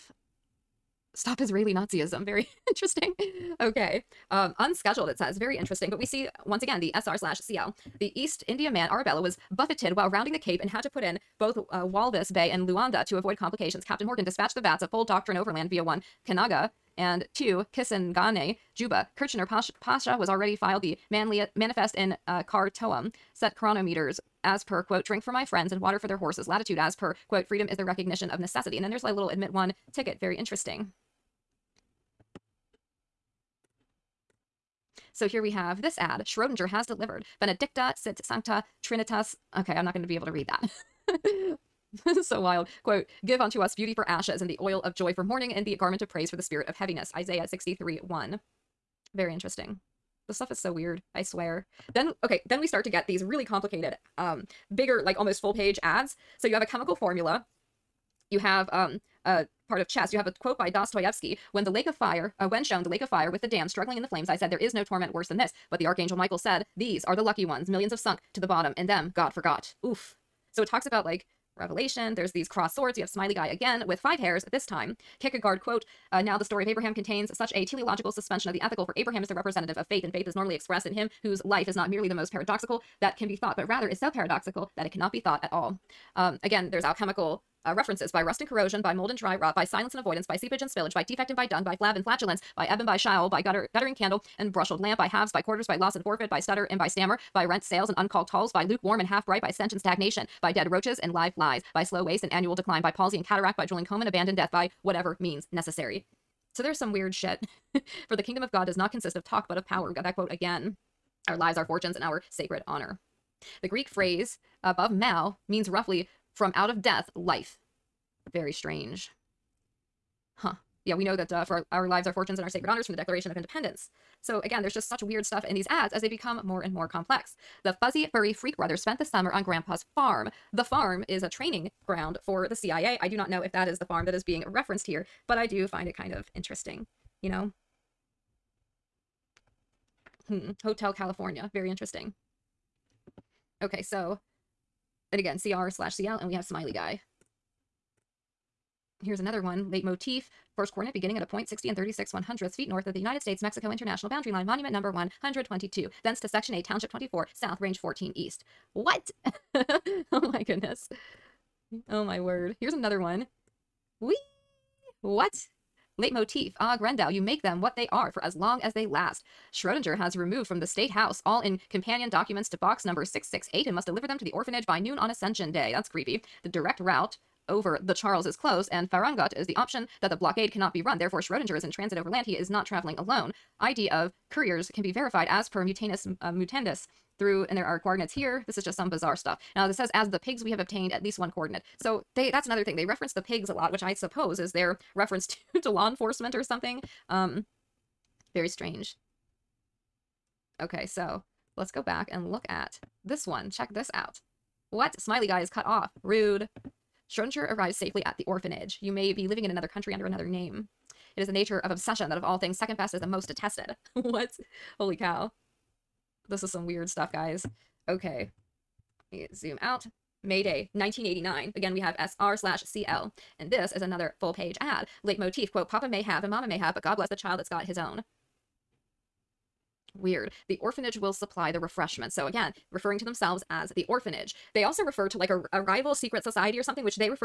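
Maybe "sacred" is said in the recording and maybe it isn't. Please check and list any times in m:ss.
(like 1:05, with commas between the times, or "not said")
1:52, 2:02.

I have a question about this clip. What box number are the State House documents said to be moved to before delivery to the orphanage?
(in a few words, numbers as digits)
668.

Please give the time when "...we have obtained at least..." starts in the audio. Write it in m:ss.
3:10.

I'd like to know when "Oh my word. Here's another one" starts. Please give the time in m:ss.
2:41.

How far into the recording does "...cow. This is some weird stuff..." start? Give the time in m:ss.
3:34.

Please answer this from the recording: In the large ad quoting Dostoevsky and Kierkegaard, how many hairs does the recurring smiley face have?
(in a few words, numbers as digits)
5.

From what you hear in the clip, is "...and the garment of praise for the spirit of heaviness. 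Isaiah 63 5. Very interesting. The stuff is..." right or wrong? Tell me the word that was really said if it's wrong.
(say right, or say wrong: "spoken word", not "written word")
wrong: "1", not "5".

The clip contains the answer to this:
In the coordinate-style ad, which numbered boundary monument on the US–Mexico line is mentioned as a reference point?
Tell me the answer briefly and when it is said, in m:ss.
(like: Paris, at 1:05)
122, at 2:34.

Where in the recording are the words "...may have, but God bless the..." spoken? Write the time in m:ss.
3:46.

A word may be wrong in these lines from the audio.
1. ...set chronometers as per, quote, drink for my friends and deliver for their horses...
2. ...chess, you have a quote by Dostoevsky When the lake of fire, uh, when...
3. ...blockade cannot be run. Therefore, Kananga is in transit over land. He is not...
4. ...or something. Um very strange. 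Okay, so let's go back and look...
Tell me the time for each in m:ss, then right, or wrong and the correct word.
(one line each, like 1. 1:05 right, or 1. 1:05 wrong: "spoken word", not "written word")
1. 0:23 wrong: "water", not "deliver"
2. 0:59 right
3. 3:00 wrong: "Schrodinger", not "Kananga"
4. 3:16 right.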